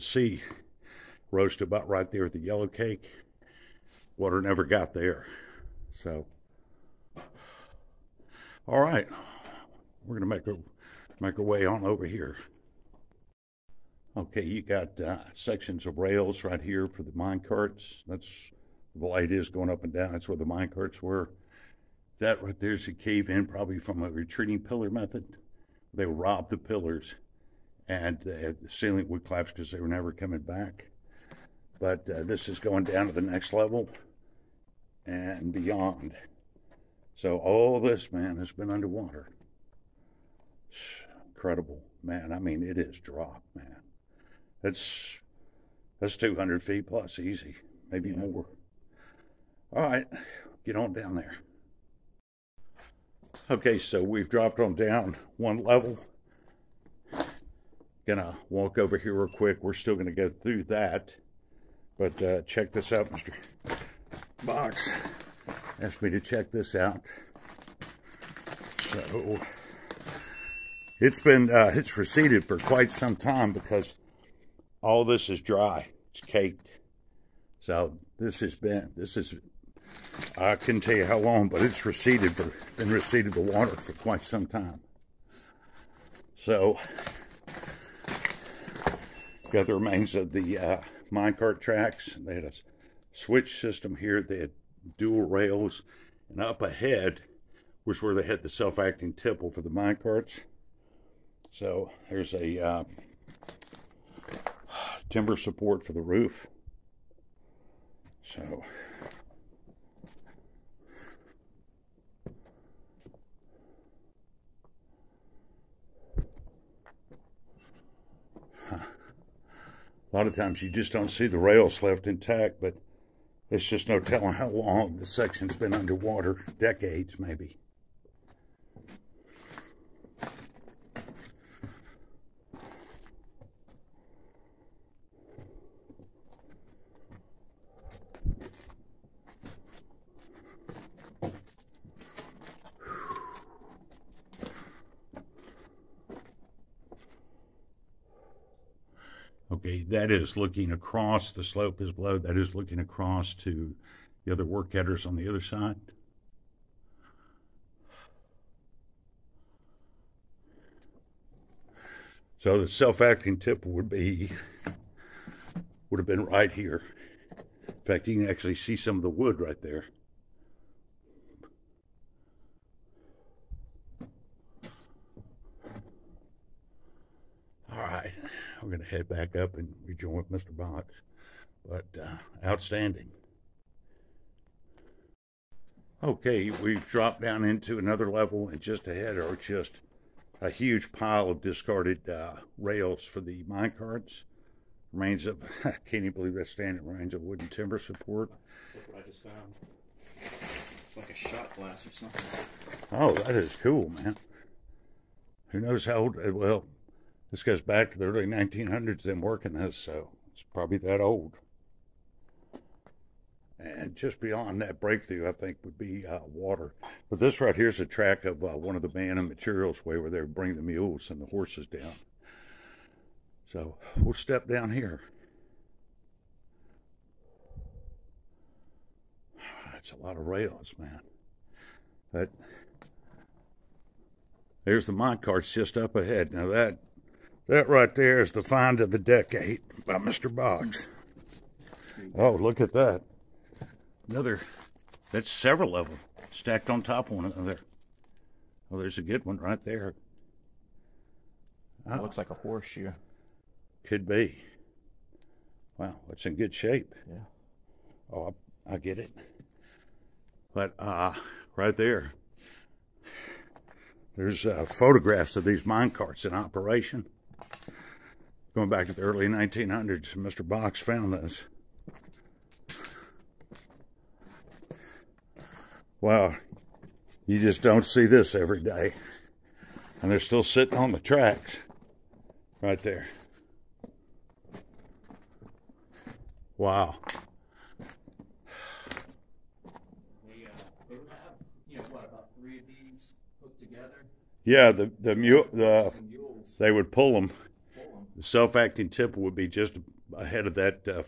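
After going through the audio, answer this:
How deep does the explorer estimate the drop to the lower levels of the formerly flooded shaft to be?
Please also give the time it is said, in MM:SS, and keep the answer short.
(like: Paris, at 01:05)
200 feet plus, at 00:46.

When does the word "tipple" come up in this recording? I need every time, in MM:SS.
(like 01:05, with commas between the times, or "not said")
01:39, 04:58.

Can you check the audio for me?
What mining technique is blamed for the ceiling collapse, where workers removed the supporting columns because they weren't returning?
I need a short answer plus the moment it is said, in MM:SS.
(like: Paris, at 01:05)
retreating pillar method, at 00:24.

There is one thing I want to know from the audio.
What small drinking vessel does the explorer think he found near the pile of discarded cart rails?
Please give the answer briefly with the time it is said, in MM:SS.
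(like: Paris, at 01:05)
shot glass, at 03:21.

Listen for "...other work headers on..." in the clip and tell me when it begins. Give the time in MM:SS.
02:34.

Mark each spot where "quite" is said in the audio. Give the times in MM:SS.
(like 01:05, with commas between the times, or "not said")
01:12, 01:23.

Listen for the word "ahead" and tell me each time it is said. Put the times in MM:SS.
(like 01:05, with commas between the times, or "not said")
01:36, 03:08, 03:55, 05:00.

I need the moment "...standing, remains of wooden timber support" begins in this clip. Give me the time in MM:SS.
03:16.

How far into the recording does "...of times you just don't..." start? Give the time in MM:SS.
02:00.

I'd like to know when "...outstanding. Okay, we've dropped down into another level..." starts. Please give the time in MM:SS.
03:02.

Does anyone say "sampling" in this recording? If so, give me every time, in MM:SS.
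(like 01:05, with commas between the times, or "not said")
not said.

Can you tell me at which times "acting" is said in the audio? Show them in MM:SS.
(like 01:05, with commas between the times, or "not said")
01:38, 02:42, 04:58.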